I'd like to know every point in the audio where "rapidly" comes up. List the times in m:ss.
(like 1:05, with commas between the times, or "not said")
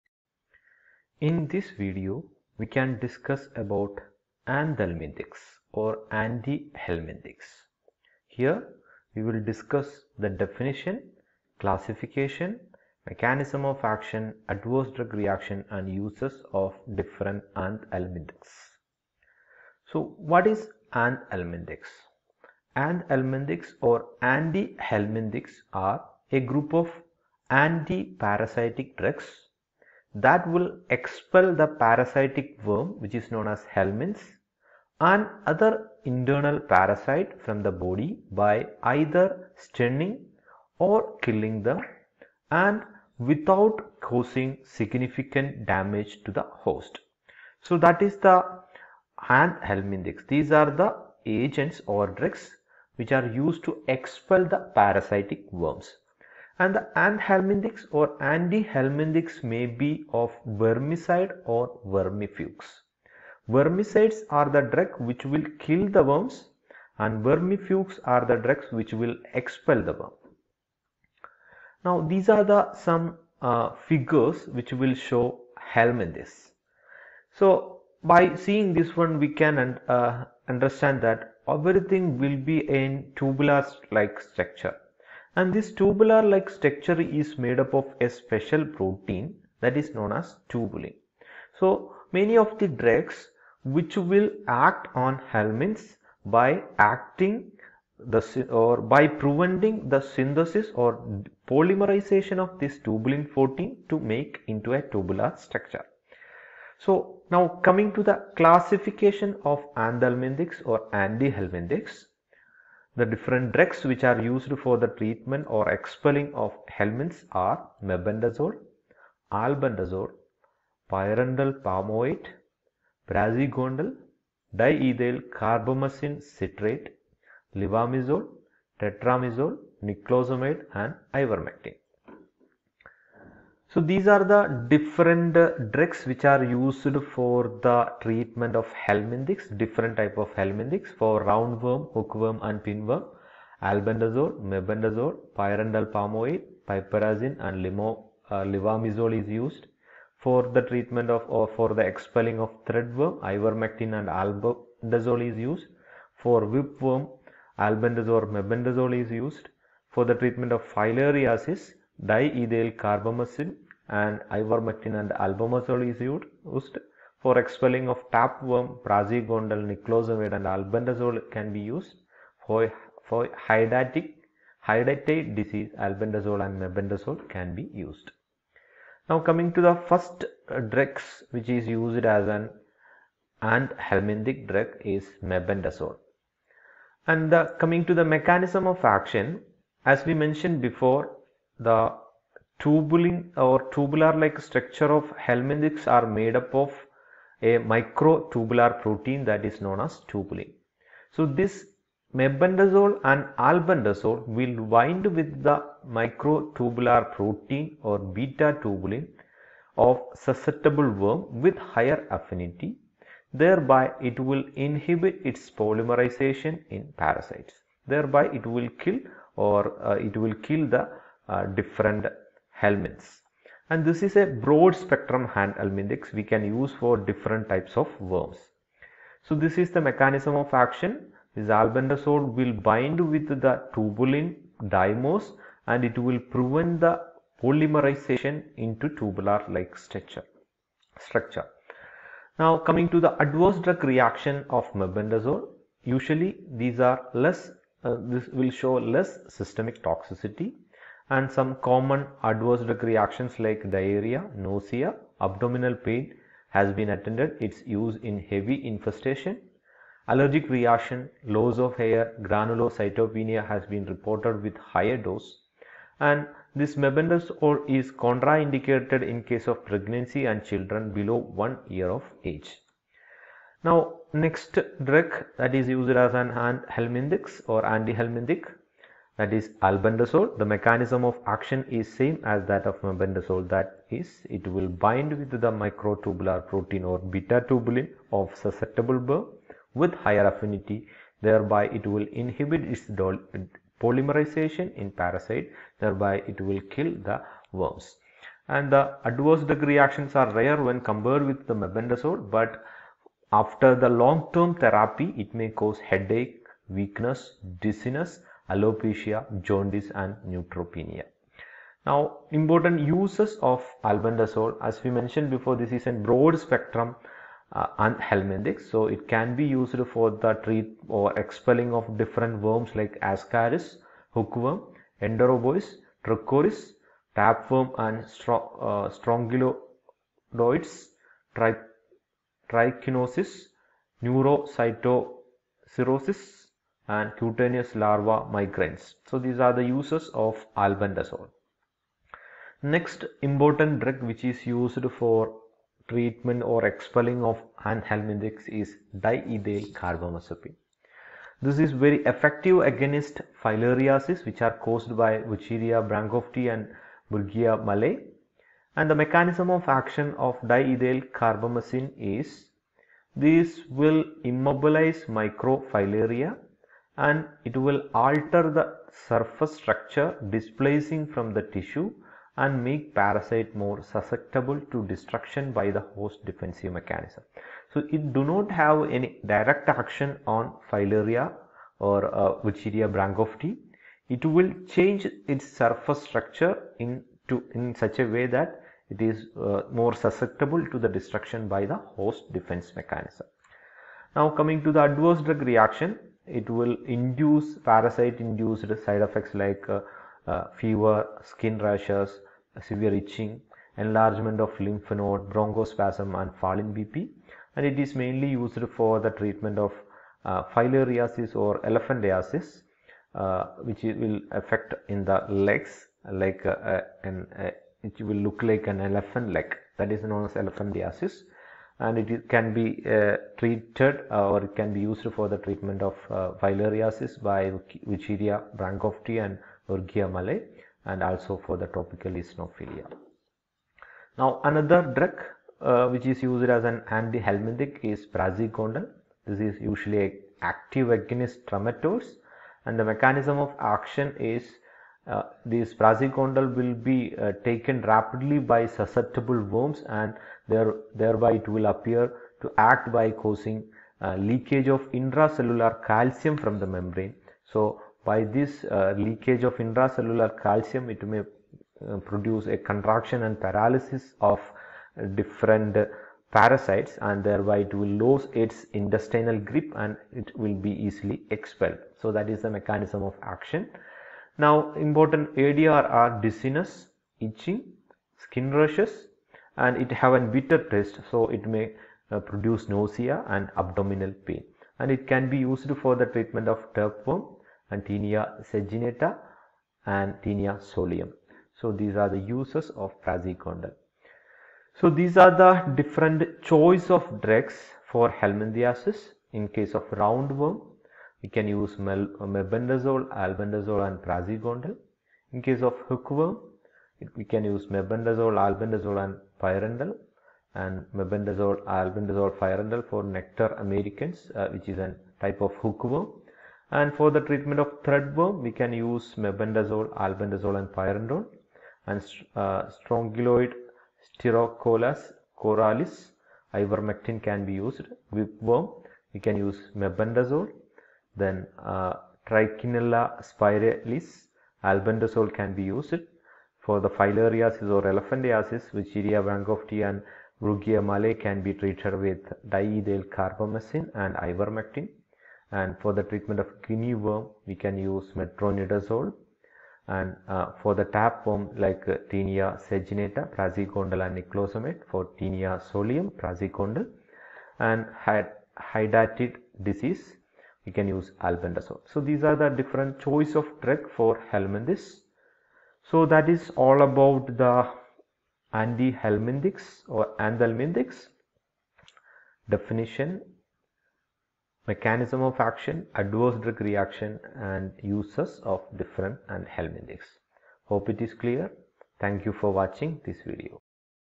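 7:27.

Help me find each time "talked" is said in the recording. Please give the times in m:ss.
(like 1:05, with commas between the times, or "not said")
not said.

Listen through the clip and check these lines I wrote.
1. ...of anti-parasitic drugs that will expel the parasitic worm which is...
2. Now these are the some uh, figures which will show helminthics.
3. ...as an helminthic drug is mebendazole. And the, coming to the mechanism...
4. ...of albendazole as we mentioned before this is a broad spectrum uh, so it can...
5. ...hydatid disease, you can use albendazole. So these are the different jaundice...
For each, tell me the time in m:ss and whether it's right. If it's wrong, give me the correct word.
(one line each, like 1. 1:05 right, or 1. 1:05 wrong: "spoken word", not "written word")
1. 0:26 right
2. 1:11 right
3. 3:02 right
4. 5:13 right
5. 9:18 wrong: "choice", not "jaundice".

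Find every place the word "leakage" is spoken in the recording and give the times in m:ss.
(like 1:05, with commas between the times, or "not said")
7:34, 7:38.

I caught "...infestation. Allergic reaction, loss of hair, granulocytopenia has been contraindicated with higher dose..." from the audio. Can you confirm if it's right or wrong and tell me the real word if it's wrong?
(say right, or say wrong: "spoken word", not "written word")
wrong: "reported", not "contraindicated".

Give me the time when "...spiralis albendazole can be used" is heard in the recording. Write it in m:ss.
8:53.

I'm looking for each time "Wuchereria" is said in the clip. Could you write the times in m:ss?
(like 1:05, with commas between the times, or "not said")
5:55, 6:22, 7:07, 8:58.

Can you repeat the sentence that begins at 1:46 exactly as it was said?
So now coming to the classification of anthelminthics or antihelminthics.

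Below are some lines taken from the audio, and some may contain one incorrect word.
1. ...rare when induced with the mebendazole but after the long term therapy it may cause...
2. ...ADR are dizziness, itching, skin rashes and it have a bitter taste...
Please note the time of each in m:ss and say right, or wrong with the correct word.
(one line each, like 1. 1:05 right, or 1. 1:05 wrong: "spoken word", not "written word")
1. 5:00 wrong: "compared", not "induced"
2. 7:55 right.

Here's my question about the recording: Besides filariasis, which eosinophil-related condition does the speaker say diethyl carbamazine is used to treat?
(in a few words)
Tropical eosinophilia.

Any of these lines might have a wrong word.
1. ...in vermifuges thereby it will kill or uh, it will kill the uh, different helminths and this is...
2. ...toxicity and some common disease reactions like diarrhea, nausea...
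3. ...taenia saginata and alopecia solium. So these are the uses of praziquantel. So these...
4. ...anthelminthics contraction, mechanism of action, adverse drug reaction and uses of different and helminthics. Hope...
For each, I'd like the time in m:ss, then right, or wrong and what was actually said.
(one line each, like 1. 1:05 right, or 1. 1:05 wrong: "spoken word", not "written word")
1. 3:36 wrong: "parasites", not "vermifuges"
2. 4:09 wrong: "adverse", not "disease"
3. 8:07 wrong: "taenia", not "alopecia"
4. 9:30 wrong: "definition", not "contraction".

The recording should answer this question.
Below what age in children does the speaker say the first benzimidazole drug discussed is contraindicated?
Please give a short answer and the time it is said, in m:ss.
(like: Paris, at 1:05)
1 year, at 4:31.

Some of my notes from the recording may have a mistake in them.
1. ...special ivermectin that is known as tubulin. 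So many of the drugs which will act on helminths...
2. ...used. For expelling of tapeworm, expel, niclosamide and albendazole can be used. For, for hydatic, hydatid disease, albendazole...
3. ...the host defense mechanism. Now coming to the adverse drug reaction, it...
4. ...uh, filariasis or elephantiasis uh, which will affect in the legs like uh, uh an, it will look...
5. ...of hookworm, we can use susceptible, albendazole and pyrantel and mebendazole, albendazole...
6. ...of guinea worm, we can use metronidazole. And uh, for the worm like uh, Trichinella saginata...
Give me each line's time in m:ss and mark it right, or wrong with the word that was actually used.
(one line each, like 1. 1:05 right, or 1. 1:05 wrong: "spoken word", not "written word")
1. 1:28 wrong: "protein", not "ivermectin"
2. 2:45 wrong: "praziquantel", not "expel"
3. 6:31 right
4. 6:50 right
5. 8:25 wrong: "mebendazole", not "susceptible"
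6. 9:06 wrong: "Taenia", not "Trichinella".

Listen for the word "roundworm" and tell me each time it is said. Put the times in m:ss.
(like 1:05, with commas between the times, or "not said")
2:21, 8:19.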